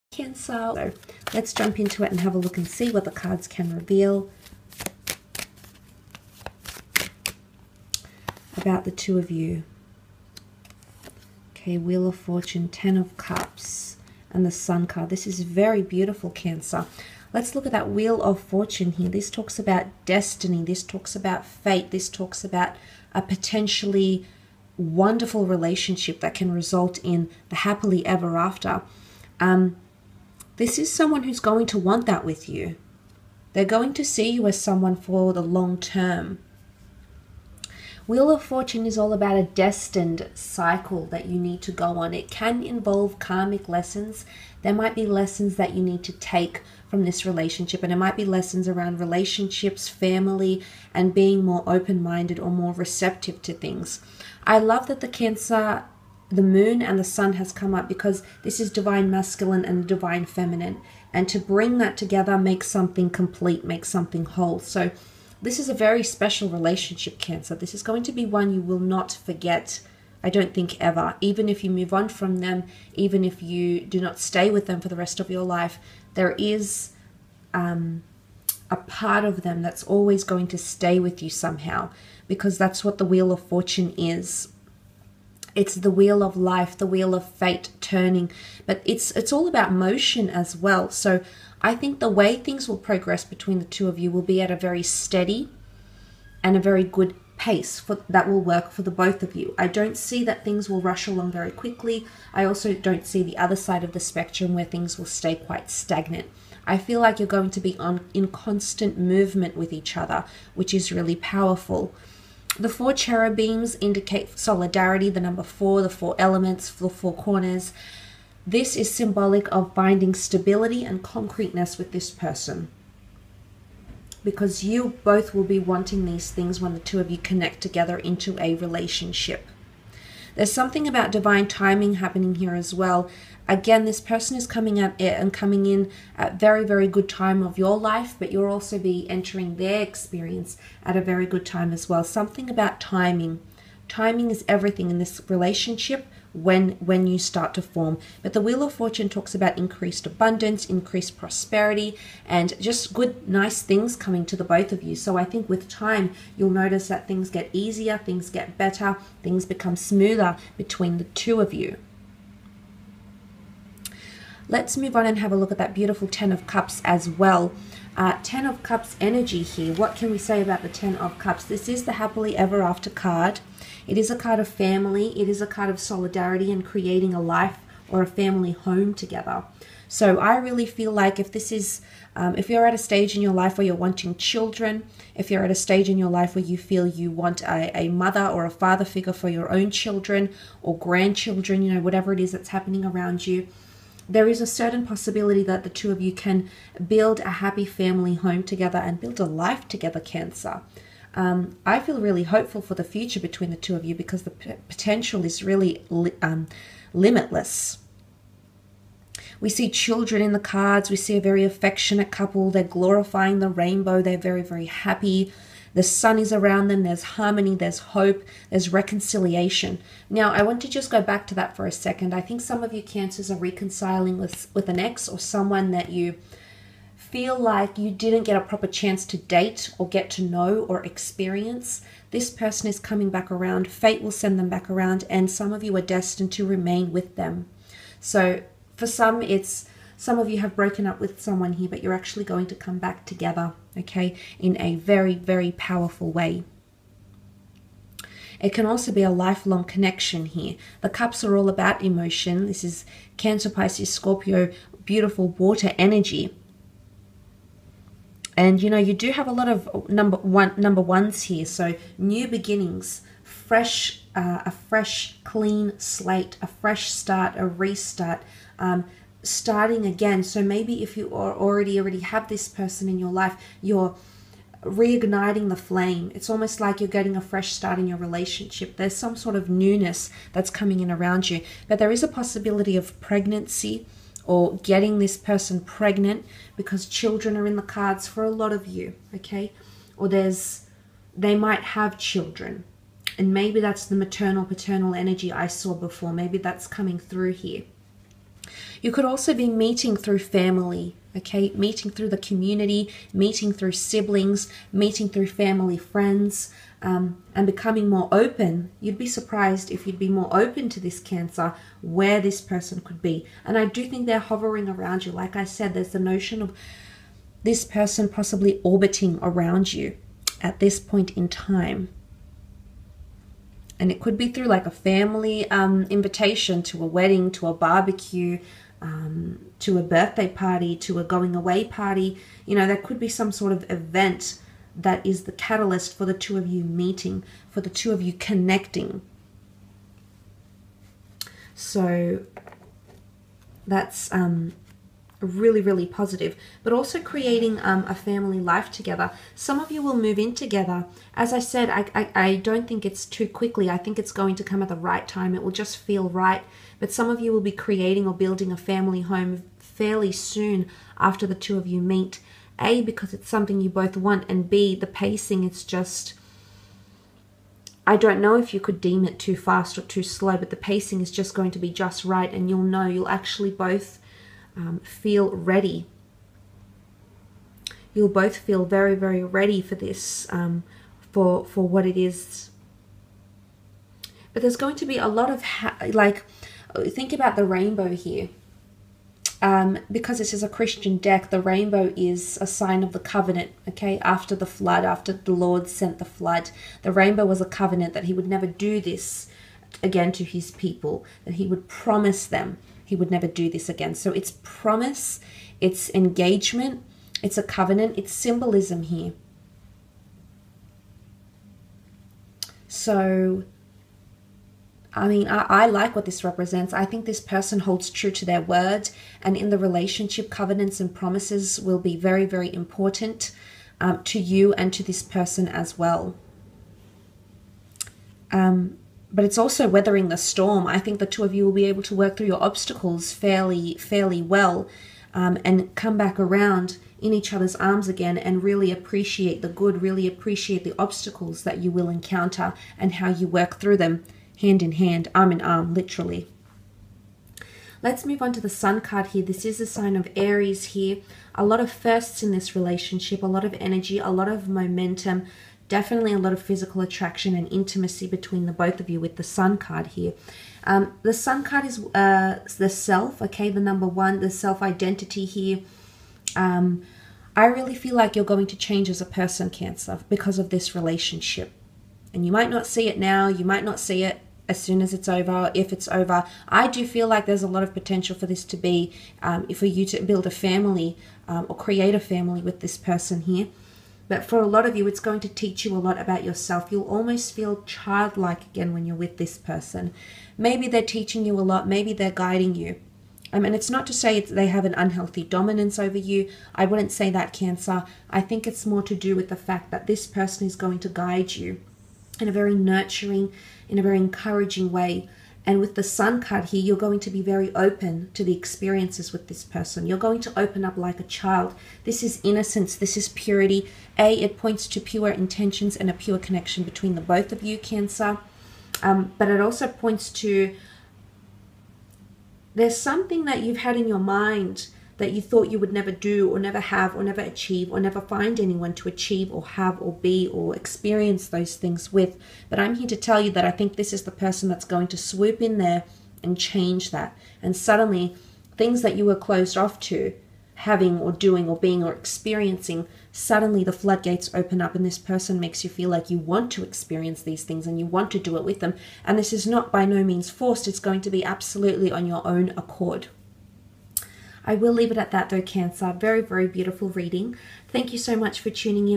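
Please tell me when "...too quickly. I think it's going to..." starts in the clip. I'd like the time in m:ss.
5:53.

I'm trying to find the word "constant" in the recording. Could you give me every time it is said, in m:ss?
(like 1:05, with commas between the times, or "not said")
1:48.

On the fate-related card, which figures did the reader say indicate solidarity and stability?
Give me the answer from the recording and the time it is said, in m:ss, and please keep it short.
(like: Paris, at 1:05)
four cherubims, at 1:52.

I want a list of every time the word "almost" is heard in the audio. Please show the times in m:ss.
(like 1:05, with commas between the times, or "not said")
4:36, 8:06.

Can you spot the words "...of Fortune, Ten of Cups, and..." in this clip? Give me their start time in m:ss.
0:12.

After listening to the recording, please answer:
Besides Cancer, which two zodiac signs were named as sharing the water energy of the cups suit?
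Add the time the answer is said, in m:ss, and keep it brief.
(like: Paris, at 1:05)
Pisces, Scorpio, at 4:13.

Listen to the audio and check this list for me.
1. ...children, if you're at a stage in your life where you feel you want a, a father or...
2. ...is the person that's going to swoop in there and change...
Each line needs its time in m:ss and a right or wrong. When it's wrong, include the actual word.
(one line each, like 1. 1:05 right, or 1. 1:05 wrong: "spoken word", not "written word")
1. 3:04 wrong: "mother", not "father"
2. 8:53 right.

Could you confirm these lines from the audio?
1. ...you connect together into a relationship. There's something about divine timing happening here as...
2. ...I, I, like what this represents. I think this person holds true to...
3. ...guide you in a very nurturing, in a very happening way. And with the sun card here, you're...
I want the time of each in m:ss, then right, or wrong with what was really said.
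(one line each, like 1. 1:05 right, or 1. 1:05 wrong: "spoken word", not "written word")
1. 2:07 right
2. 6:55 right
3. 8:20 wrong: "encouraging", not "happening".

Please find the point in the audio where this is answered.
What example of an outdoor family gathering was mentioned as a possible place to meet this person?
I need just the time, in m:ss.
5:27.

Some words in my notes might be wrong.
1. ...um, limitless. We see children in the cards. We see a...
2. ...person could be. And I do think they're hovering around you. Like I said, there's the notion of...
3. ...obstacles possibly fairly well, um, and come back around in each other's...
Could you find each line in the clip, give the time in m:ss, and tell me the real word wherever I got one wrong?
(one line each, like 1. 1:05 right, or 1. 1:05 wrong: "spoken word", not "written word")
1. 3:26 right
2. 5:12 right
3. 7:12 wrong: "fairly", not "possibly".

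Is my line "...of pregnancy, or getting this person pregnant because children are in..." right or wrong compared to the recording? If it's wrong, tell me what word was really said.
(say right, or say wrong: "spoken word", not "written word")
right.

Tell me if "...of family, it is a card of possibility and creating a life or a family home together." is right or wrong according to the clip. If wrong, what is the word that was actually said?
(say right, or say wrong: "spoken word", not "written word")
wrong: "solidarity", not "possibility".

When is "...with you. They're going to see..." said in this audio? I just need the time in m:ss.
0:32.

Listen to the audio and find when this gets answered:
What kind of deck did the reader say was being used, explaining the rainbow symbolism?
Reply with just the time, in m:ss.
6:30.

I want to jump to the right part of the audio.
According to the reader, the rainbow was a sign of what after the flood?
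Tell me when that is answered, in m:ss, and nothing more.
6:32.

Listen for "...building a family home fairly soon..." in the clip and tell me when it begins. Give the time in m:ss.
5:58.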